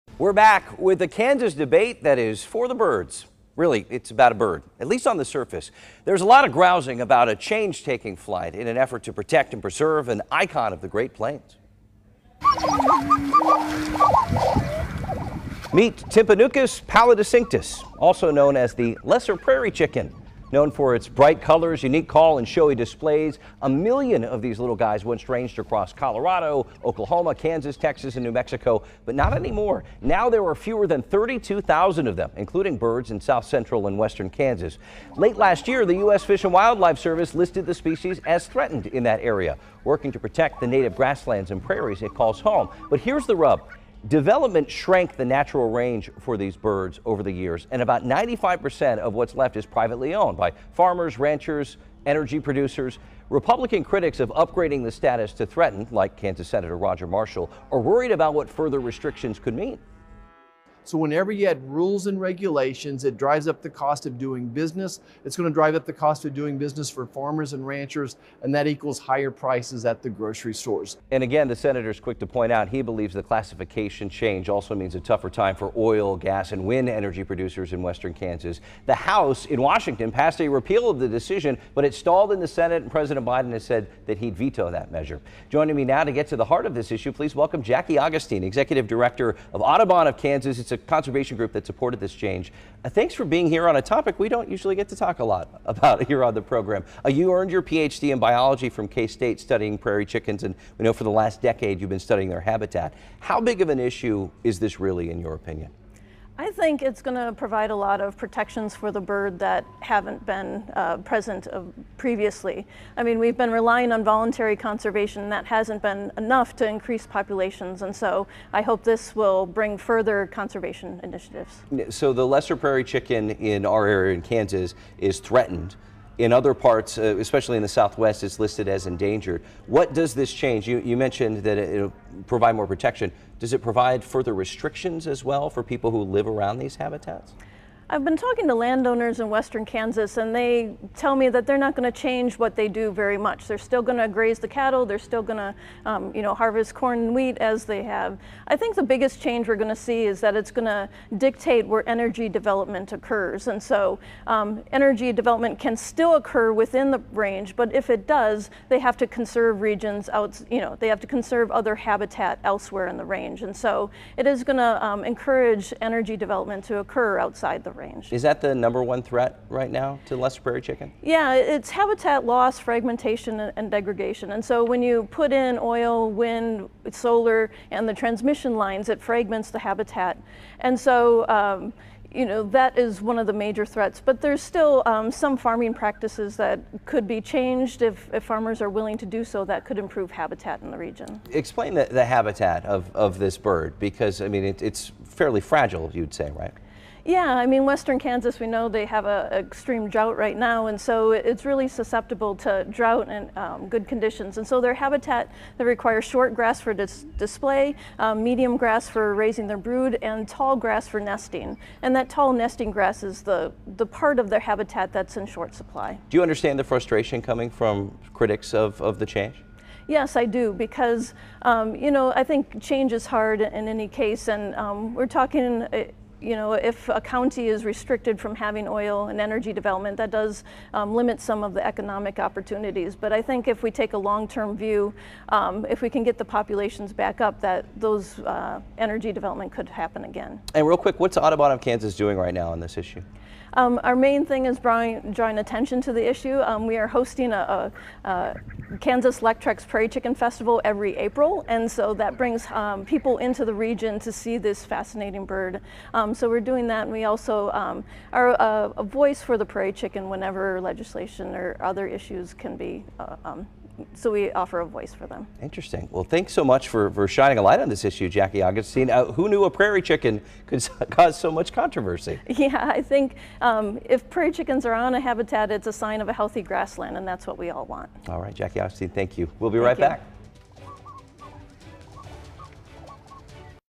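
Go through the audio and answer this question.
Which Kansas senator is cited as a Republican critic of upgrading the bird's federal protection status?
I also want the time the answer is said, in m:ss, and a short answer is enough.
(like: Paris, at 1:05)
Roger Marshall, at 0:56.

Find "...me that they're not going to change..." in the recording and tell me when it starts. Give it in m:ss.
2:21.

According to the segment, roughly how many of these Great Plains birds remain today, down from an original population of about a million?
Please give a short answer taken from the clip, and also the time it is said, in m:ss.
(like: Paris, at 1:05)
fewer than 32,000, at 0:30.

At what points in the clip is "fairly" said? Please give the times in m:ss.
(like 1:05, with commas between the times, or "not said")
3:15.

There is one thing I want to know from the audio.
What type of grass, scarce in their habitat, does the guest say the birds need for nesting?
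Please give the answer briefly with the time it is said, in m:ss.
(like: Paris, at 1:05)
tall grass, at 3:30.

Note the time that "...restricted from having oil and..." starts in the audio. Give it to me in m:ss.
3:47.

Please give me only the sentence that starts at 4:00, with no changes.
And real quick, what's Audubon of Kansas doing right now on this issue?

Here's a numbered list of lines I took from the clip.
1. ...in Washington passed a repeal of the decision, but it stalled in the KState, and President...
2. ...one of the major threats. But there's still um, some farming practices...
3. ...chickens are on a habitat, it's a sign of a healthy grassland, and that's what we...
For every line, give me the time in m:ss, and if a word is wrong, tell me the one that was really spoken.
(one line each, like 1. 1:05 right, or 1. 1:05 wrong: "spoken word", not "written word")
1. 1:19 wrong: "Senate", not "KState"
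2. 3:03 right
3. 4:34 right.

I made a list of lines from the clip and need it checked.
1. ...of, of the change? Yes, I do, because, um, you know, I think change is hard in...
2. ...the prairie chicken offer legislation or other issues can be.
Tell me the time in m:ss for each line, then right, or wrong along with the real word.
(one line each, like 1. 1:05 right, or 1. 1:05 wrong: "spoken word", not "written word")
1. 3:38 right
2. 4:19 wrong: "whenever", not "offer".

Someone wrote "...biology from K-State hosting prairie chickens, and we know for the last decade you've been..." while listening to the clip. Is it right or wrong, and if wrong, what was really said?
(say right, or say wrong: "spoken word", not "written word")
wrong: "studying", not "hosting".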